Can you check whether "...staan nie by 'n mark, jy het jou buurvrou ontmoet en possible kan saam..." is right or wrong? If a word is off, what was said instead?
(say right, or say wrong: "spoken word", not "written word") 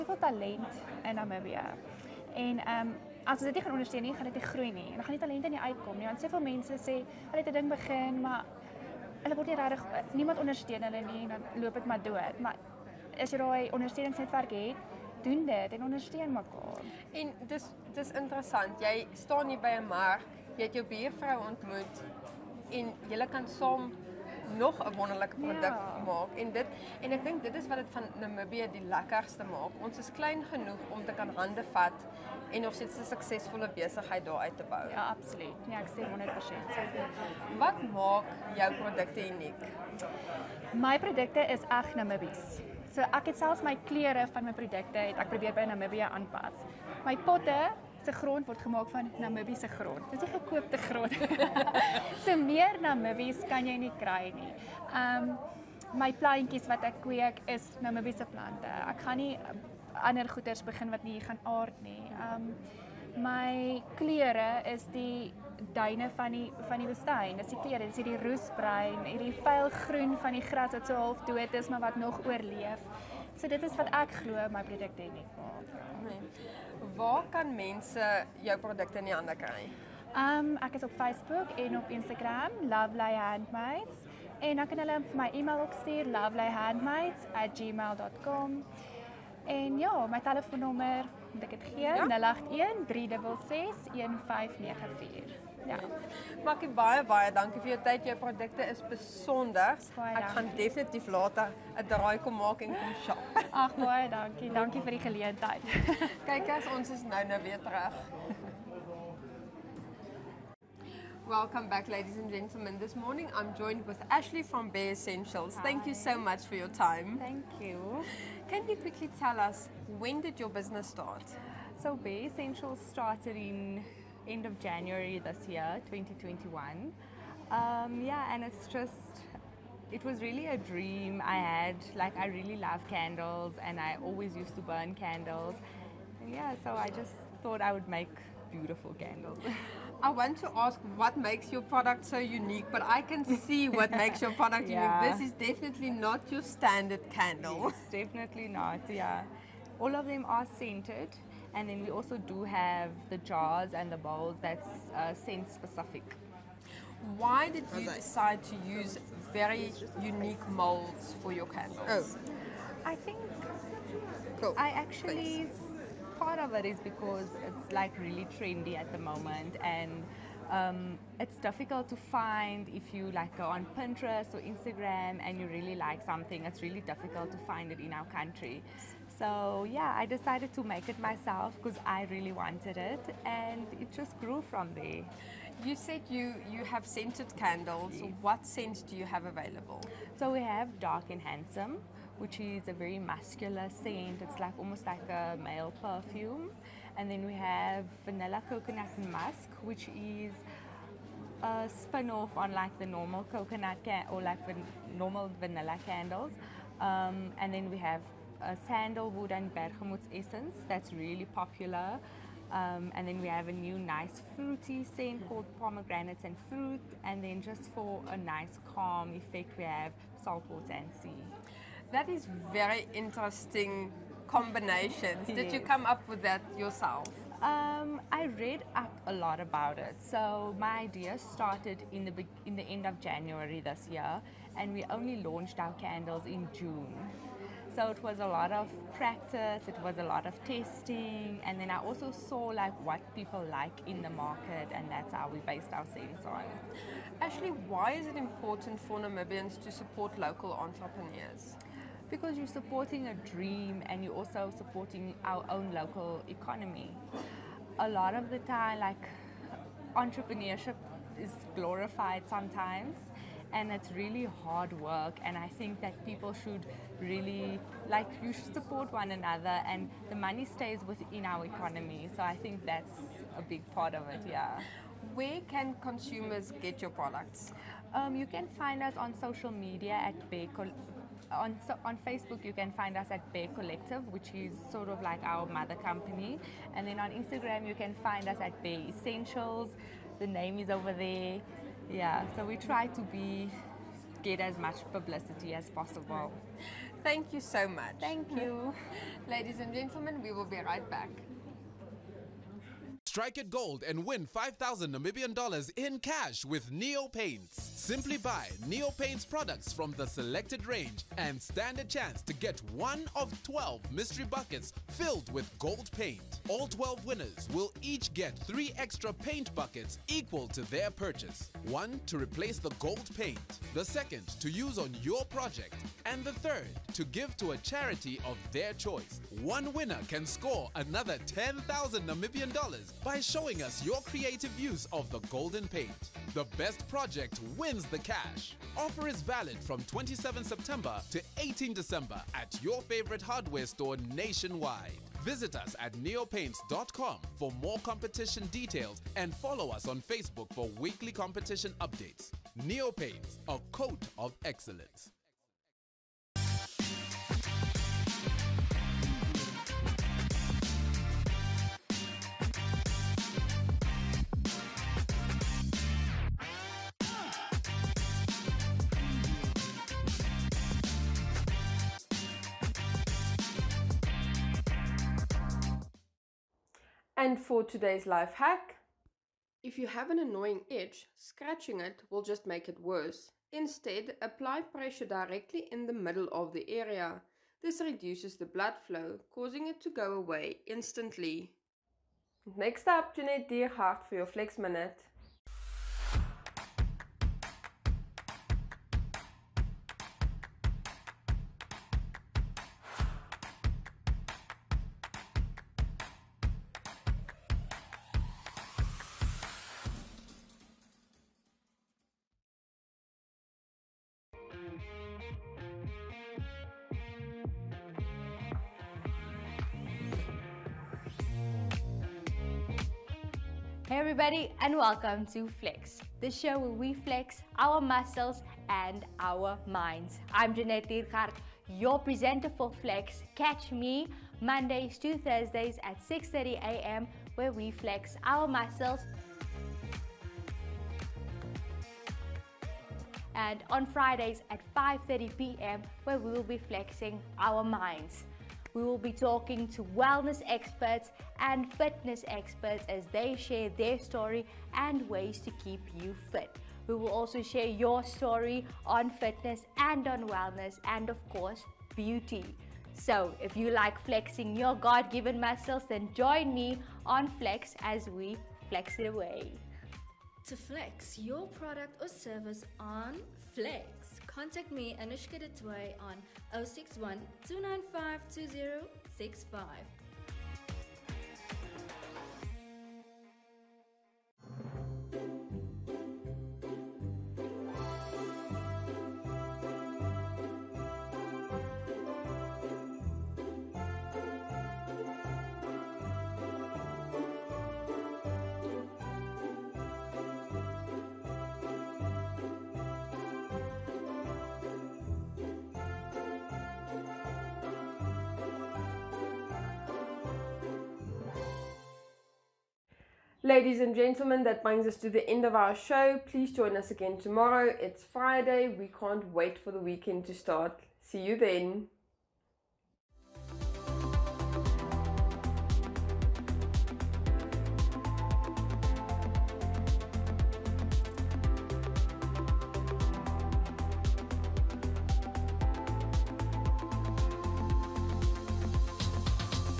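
wrong: "julle", not "possible".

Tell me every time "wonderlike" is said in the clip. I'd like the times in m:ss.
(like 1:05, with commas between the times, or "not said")
0:24.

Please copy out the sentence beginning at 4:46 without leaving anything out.
And then on Instagram, you can find us at Bare Essentials.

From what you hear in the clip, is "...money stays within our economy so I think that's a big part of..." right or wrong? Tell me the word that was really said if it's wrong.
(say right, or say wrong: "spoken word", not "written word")
right.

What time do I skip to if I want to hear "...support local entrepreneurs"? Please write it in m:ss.
4:09.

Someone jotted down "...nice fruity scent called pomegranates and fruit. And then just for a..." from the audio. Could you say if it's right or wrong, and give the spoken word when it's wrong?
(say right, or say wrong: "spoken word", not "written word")
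right.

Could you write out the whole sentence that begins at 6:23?
Instead, apply pressure directly in the middle of the area.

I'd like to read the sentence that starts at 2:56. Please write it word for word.
It's really difficult to find it in our country.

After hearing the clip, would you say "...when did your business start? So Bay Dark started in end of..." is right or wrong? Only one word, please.
wrong.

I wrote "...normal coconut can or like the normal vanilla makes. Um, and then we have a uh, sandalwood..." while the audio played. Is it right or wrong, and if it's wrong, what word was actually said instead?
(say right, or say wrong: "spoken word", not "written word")
wrong: "candles", not "makes".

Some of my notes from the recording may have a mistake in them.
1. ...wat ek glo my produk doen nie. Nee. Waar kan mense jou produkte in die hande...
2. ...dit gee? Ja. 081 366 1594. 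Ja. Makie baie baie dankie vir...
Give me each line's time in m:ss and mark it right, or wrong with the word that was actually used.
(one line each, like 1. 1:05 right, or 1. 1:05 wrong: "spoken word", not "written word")
1. 1:13 right
2. 1:31 right.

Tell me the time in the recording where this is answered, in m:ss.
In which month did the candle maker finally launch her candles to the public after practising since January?
3:56.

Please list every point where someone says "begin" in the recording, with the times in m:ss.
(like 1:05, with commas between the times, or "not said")
0:07, 1:00.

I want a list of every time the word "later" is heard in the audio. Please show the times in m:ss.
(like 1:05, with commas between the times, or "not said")
1:41.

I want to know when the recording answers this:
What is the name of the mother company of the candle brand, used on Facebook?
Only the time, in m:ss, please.
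4:43.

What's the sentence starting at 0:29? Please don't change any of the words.
Ons is klein genoeg om te kan hande vat en nog steeds 'n suksesvolle besigheid daar uit te bou.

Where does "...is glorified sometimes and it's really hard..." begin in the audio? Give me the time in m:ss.
4:21.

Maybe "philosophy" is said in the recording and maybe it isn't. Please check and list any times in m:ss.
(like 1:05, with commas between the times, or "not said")
not said.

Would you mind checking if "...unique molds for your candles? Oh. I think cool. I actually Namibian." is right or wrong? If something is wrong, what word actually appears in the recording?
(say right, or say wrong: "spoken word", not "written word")
wrong: "Thanks", not "Namibian".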